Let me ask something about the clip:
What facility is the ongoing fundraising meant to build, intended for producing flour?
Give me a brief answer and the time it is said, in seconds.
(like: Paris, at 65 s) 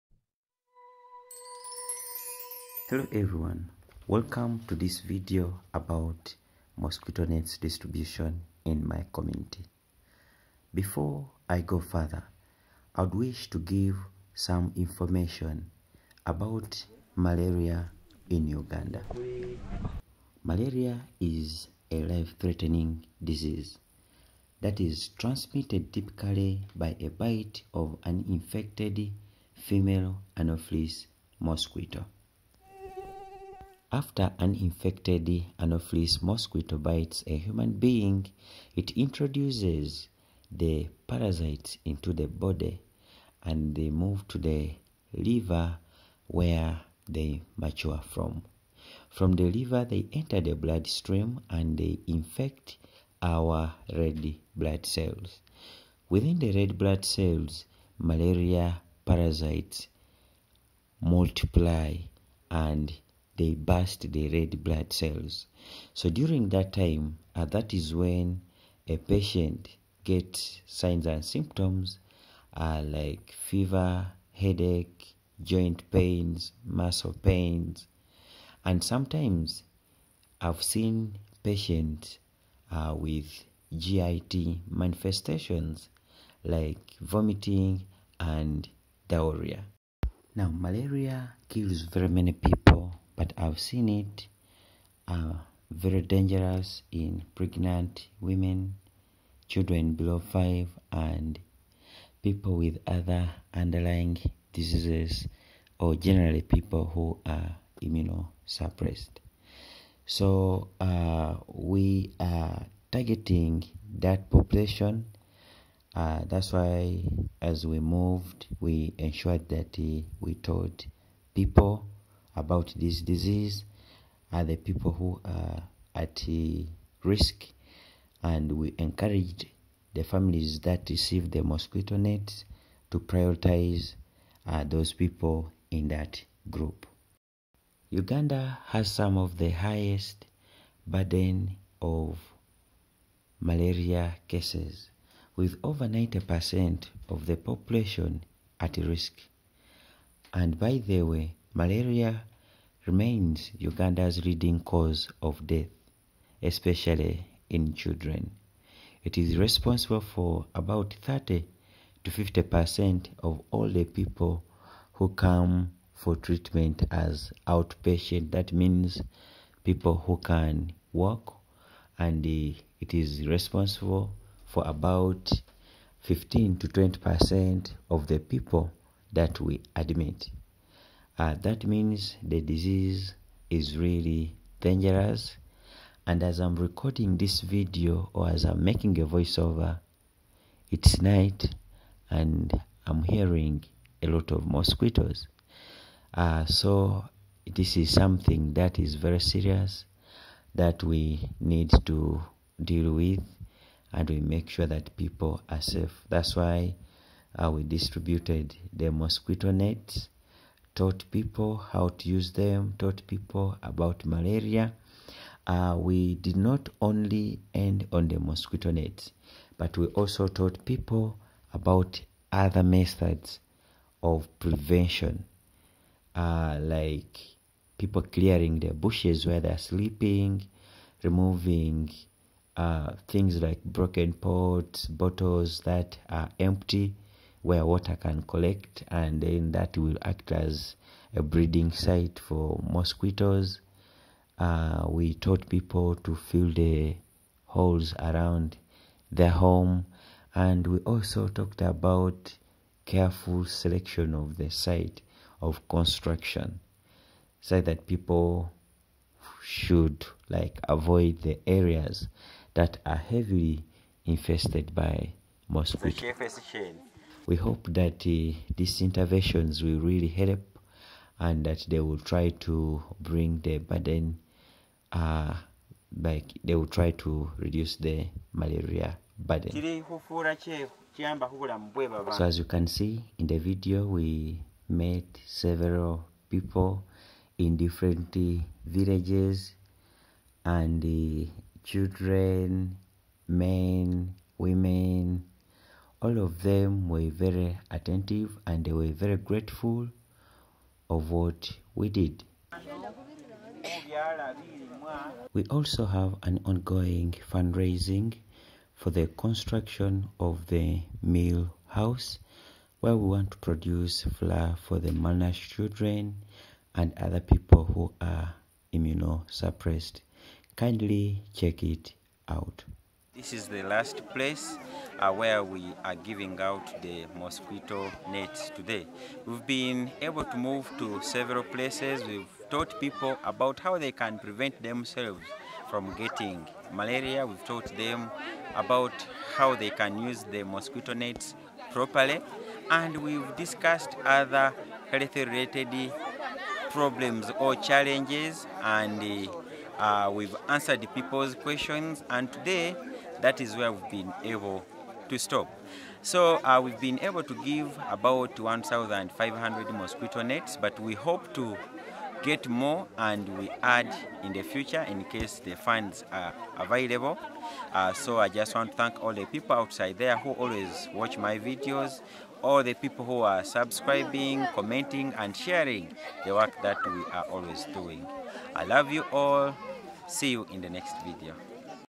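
meal house, at 311 s.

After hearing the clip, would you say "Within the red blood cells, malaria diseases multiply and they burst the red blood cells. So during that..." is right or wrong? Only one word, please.
wrong.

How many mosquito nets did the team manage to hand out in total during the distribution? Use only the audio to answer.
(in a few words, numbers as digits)
1,500.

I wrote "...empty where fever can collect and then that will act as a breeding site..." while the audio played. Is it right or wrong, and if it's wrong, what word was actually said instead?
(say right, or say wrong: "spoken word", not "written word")
wrong: "water", not "fever".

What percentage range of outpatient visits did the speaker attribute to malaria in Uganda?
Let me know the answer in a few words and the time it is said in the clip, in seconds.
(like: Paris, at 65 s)
30 to 50 percent, at 161 s.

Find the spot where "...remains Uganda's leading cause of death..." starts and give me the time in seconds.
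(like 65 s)
152 s.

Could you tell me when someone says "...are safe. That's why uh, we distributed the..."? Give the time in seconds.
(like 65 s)
205 s.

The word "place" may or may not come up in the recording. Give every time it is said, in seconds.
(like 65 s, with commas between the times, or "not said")
324 s, 331 s.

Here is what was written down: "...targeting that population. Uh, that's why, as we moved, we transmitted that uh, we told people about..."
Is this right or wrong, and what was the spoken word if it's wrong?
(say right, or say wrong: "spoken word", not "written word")
wrong: "ensured", not "transmitted".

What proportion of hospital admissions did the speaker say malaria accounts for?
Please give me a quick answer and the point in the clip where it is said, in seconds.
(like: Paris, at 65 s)
15 to 20 percent, at 175 s.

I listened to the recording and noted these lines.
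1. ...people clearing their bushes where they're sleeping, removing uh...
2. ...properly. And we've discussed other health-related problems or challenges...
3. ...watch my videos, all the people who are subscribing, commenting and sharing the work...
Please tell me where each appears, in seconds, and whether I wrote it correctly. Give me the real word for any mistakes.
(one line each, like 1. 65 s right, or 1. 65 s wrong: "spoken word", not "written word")
1. 227 s right
2. 341 s right
3. 370 s right.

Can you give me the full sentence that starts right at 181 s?
Uh, that means the disease is really dangerous.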